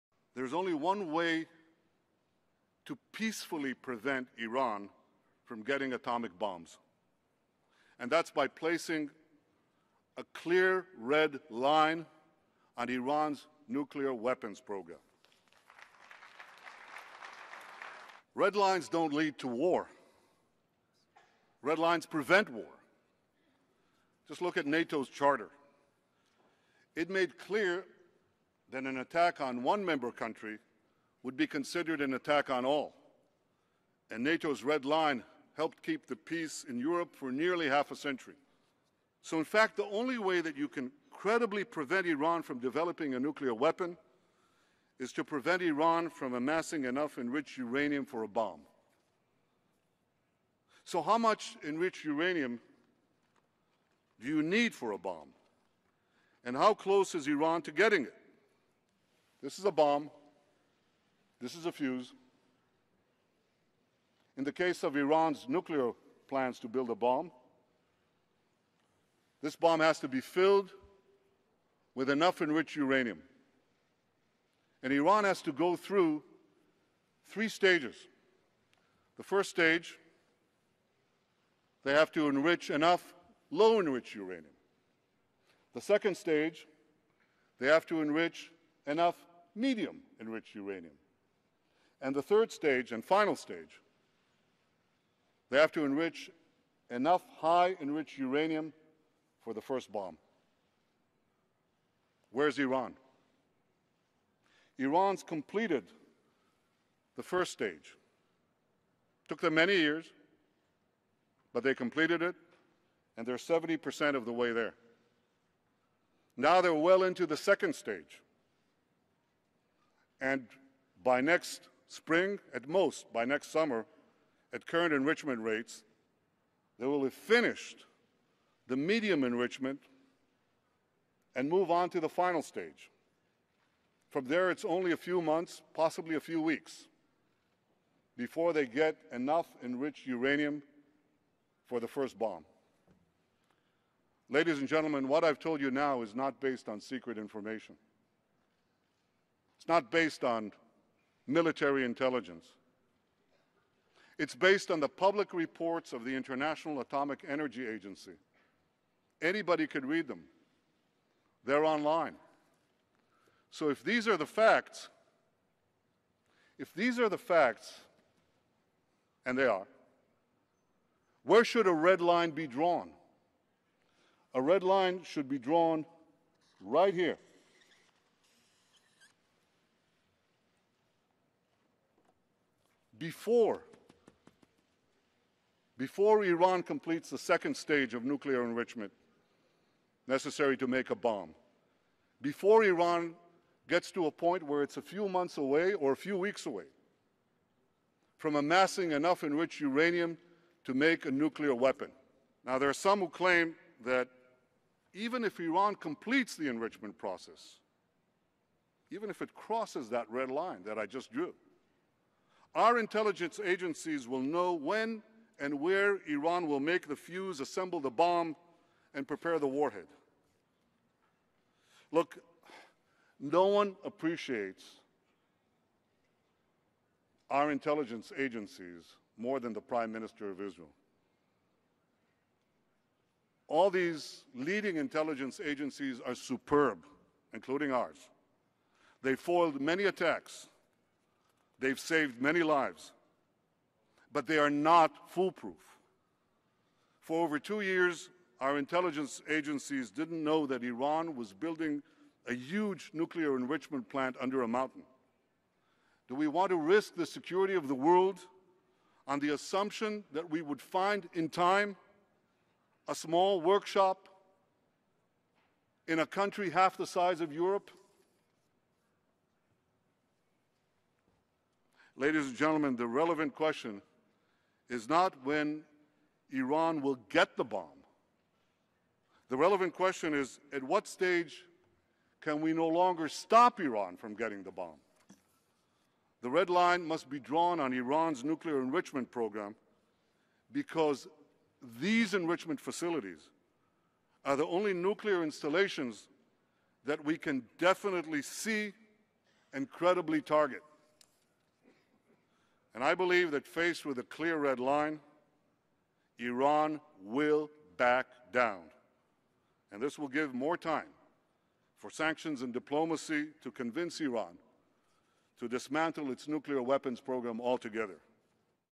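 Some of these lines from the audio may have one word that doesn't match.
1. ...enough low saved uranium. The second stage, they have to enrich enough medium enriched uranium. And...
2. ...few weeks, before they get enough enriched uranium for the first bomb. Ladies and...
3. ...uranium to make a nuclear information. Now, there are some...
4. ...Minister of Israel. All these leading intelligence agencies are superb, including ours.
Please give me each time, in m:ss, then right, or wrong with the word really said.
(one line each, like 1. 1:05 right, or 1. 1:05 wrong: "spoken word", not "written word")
1. 1:22 wrong: "enriched", not "saved"
2. 2:16 right
3. 3:19 wrong: "weapon", not "information"
4. 3:49 right.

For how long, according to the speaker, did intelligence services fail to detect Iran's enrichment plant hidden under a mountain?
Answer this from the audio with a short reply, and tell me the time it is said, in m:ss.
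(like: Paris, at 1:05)
over 2 years, at 4:07.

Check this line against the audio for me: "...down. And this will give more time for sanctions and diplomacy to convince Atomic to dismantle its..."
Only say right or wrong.
wrong.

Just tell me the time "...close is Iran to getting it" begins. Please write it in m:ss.
0:56.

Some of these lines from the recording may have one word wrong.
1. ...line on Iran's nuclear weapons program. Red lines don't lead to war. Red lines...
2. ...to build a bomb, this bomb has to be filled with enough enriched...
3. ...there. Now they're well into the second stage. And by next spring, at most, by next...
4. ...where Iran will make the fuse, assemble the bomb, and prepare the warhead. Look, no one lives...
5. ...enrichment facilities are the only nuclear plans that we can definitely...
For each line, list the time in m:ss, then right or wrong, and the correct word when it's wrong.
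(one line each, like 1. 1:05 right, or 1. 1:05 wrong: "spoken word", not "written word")
1. 0:11 right
2. 1:06 right
3. 1:54 right
4. 3:35 wrong: "appreciates", not "lives"
5. 4:52 wrong: "installations", not "plans".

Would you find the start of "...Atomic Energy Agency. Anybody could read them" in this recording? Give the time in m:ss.
2:36.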